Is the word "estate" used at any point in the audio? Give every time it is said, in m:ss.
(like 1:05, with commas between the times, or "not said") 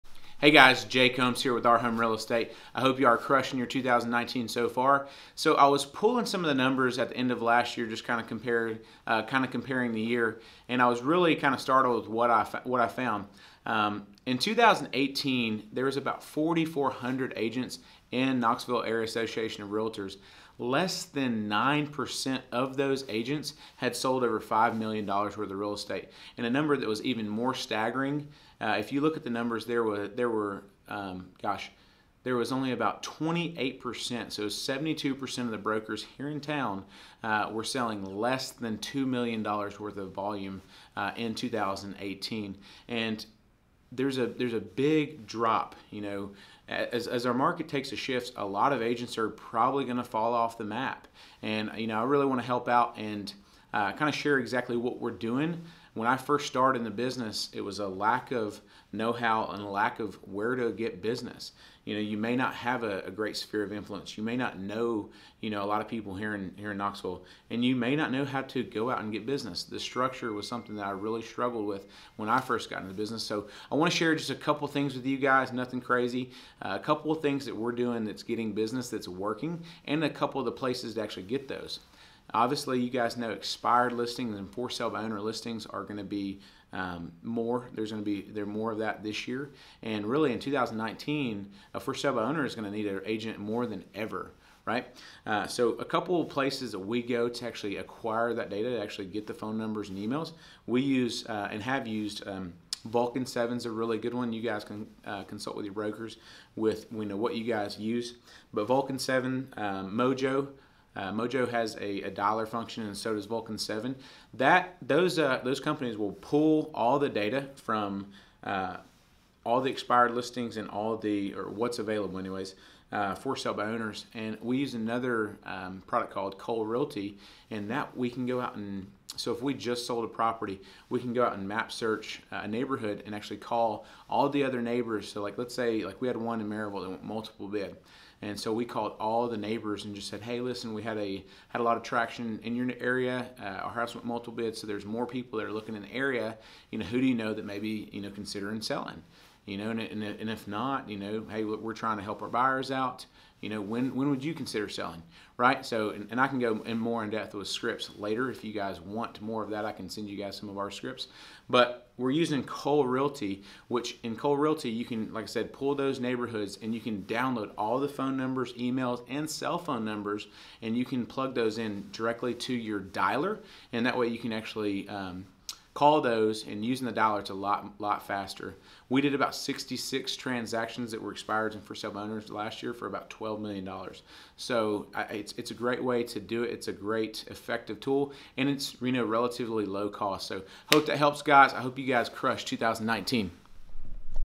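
0:02, 0:25.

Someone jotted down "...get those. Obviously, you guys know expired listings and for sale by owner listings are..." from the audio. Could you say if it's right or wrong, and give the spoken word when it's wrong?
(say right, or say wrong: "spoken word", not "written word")
right.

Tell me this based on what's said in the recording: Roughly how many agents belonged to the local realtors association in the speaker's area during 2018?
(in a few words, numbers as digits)
4,400.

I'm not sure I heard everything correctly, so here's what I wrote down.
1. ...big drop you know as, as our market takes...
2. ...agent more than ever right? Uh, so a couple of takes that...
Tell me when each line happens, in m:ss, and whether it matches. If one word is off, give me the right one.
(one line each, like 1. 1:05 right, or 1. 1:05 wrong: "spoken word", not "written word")
1. 0:44 right
2. 1:33 wrong: "places", not "takes".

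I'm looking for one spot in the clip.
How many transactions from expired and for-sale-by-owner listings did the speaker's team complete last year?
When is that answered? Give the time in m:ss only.
2:59.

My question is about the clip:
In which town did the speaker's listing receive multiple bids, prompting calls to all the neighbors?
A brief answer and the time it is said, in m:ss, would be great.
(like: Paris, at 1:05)
Maryville, at 2:16.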